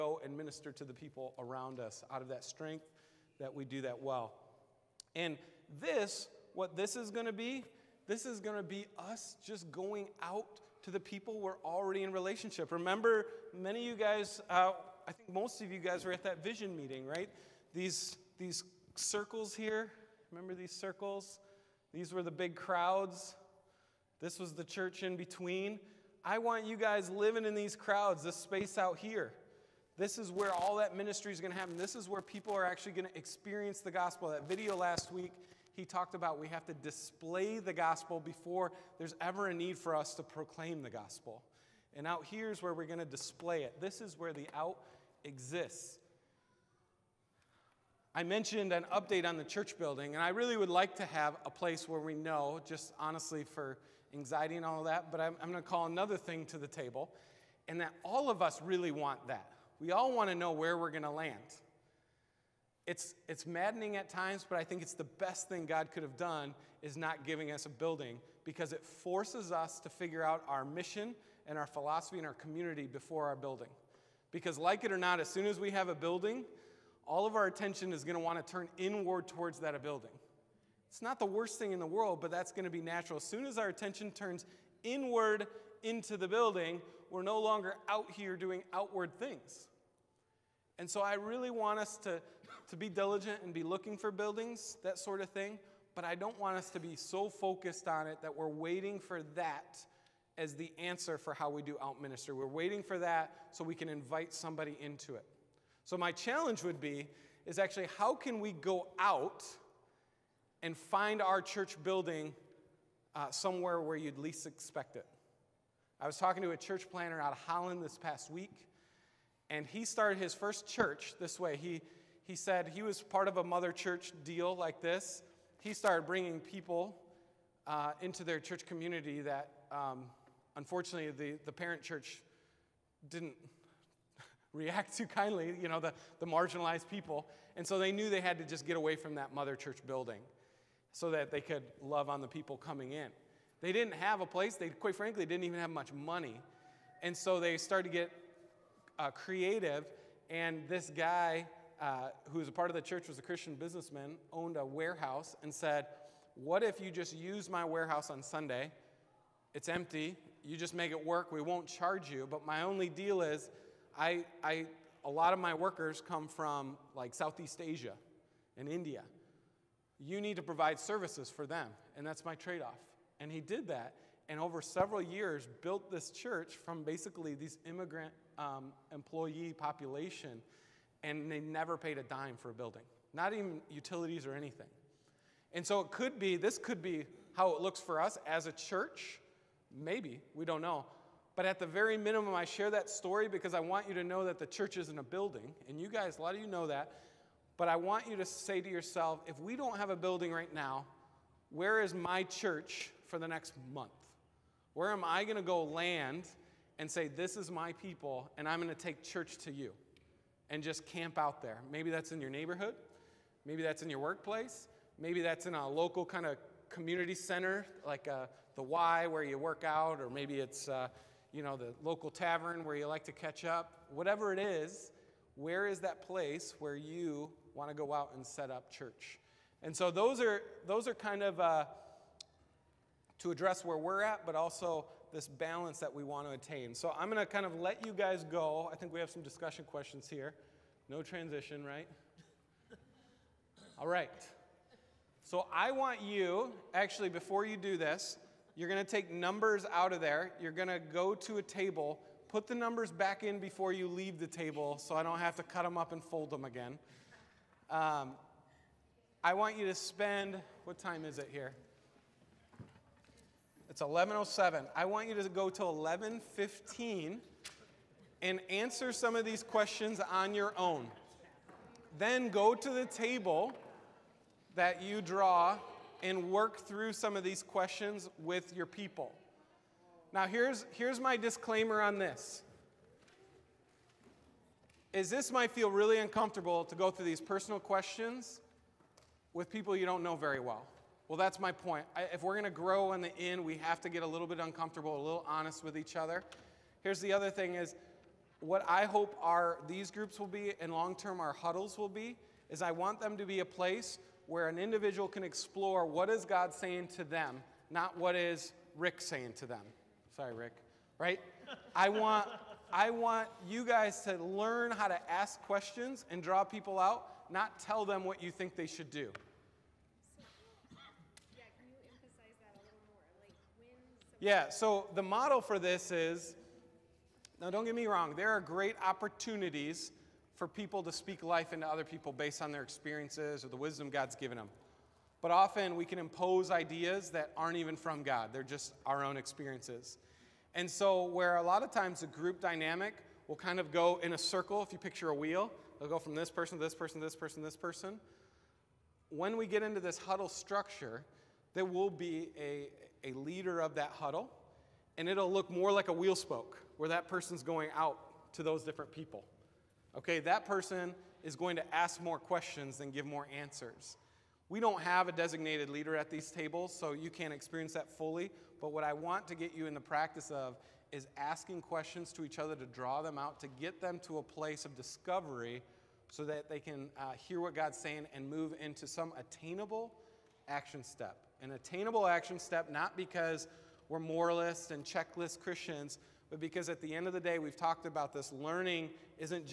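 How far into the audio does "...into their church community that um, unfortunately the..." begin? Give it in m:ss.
2:08.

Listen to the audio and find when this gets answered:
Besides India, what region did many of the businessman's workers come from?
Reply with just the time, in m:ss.
2:47.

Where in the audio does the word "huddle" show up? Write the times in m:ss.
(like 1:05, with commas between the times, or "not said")
5:01, 5:49, 5:53.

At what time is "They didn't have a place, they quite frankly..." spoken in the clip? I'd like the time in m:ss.
2:23.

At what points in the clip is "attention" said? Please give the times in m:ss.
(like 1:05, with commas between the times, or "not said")
1:17, 1:23.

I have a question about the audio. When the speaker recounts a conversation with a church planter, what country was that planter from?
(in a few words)
Holland.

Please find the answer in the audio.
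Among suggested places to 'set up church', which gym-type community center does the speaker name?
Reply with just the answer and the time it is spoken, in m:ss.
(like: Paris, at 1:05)
the Y, at 3:38.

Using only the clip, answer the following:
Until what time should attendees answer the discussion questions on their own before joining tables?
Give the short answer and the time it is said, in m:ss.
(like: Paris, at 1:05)
11:15, at 4:25.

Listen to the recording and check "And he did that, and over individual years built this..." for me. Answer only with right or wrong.
wrong.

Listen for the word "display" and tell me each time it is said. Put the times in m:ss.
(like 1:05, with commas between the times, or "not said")
0:36, 0:43.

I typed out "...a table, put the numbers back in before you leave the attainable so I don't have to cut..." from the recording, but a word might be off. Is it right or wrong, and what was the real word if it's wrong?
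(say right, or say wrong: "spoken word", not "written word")
wrong: "table", not "attainable".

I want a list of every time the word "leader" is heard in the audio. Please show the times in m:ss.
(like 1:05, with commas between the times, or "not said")
5:53, 6:05.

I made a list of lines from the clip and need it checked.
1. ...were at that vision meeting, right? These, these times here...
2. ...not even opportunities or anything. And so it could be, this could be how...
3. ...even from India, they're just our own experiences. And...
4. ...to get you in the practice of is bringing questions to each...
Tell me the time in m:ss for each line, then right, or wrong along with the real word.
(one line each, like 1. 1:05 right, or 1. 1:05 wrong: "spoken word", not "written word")
1. 0:16 wrong: "circles", not "times"
2. 3:03 wrong: "utilities", not "opportunities"
3. 5:37 wrong: "God", not "India"
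4. 6:09 wrong: "asking", not "bringing".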